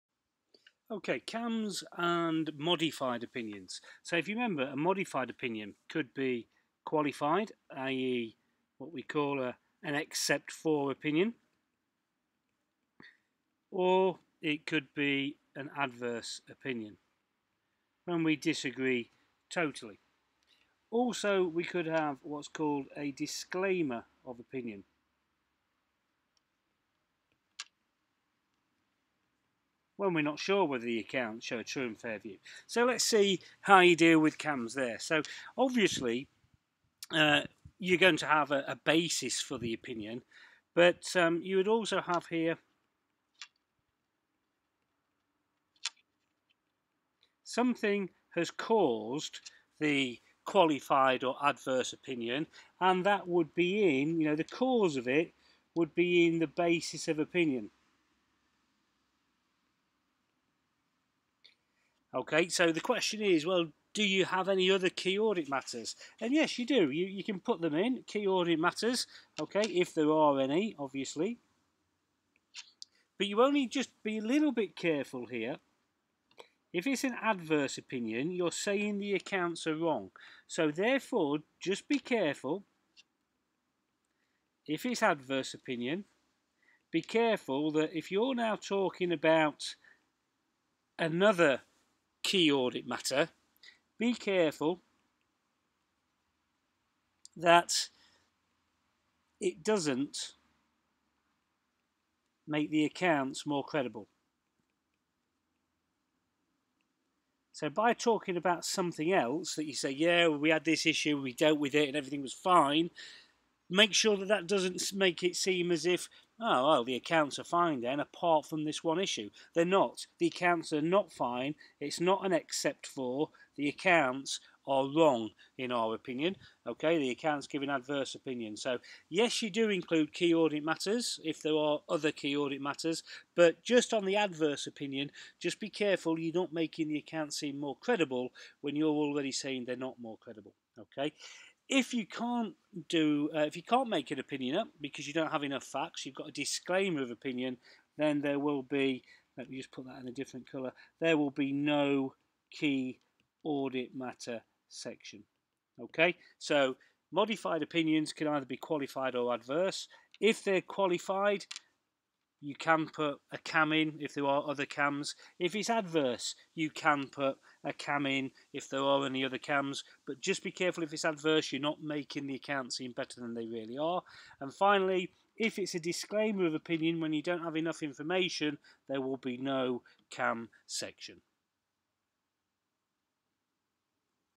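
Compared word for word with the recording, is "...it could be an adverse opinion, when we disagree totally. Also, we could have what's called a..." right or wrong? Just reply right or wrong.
right.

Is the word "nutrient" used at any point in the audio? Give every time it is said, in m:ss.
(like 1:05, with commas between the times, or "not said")
not said.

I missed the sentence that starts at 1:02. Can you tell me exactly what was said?
Okay, so the question is, well, do you have any other key audit matters?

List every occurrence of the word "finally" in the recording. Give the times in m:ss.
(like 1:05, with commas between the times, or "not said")
2:54.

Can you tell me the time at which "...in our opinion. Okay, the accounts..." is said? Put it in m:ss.
2:05.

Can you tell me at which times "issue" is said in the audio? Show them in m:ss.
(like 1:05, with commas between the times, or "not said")
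1:50, 1:58.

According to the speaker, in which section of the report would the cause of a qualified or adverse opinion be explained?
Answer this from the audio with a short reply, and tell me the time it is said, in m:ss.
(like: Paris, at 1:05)
basis of opinion, at 0:56.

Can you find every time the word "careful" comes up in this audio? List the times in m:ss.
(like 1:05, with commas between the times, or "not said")
1:14, 1:21, 1:27, 1:34, 2:15, 2:50.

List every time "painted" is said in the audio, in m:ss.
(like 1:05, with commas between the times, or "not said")
not said.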